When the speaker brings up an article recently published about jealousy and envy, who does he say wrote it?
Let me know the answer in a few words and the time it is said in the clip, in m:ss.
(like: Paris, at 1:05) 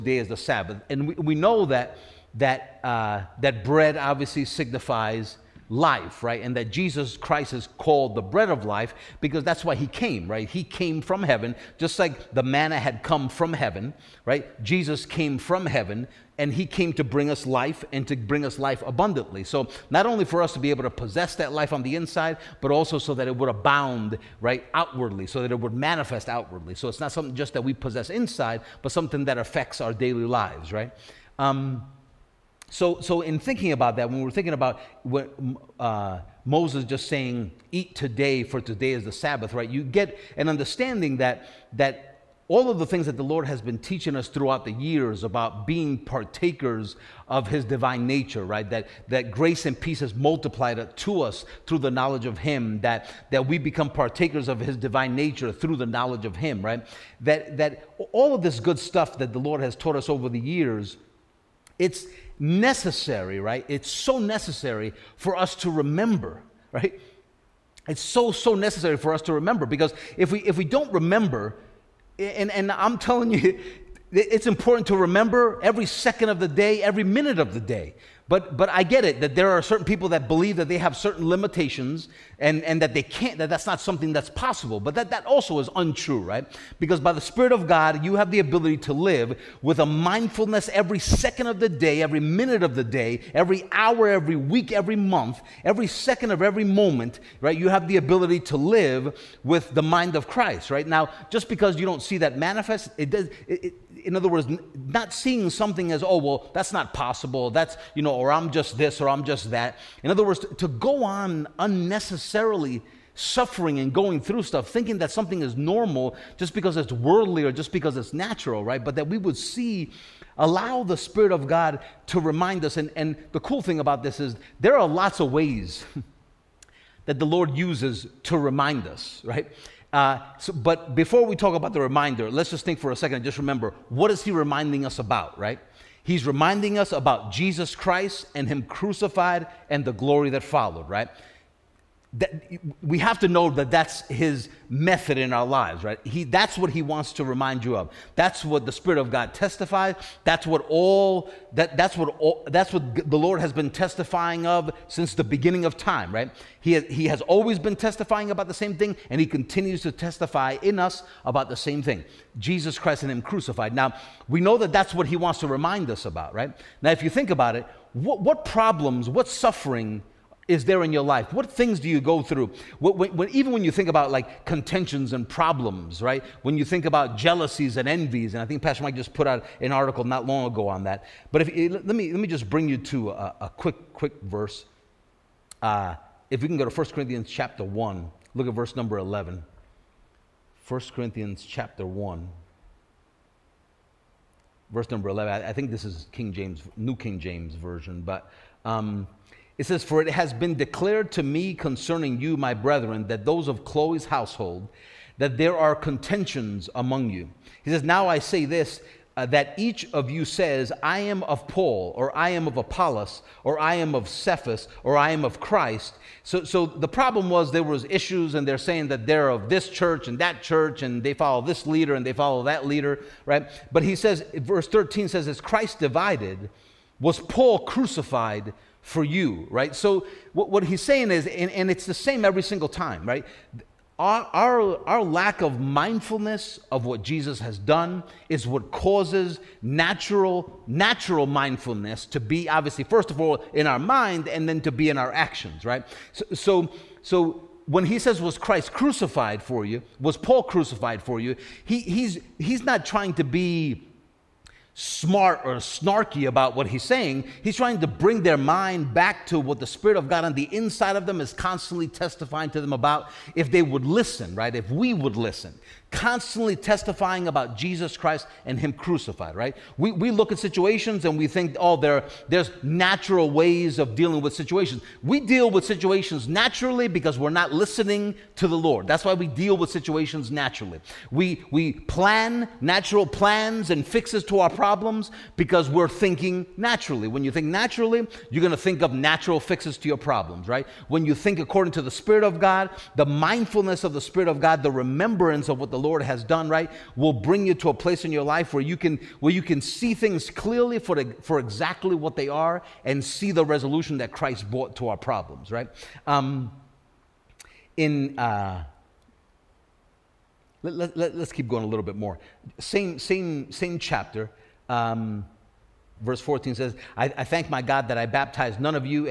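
Pastor Mike, at 2:58.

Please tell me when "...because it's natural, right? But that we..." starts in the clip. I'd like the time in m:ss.
1:57.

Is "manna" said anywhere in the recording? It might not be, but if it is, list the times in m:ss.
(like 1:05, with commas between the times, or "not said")
0:12.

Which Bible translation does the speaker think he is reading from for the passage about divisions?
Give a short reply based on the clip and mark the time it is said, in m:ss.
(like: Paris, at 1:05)
New King James Version, at 3:16.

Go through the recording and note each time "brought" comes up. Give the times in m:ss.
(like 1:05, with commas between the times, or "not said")
5:04.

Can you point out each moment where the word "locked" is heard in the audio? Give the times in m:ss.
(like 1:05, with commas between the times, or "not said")
not said.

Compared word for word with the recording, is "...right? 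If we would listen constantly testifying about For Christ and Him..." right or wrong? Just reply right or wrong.
wrong.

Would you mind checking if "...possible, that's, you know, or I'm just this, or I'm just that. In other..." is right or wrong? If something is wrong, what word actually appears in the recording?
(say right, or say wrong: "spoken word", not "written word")
right.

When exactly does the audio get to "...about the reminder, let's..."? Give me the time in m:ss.
2:11.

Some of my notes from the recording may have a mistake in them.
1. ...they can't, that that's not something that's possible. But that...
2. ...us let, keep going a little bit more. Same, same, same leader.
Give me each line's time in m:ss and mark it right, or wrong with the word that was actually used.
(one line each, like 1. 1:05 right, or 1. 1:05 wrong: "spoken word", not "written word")
1. 1:22 right
2. 5:10 wrong: "chapter", not "leader".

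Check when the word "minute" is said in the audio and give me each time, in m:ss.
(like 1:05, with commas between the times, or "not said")
1:17, 1:32.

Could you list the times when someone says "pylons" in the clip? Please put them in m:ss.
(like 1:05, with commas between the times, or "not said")
not said.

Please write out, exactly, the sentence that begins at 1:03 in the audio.
It's so necessary for us to remember, right?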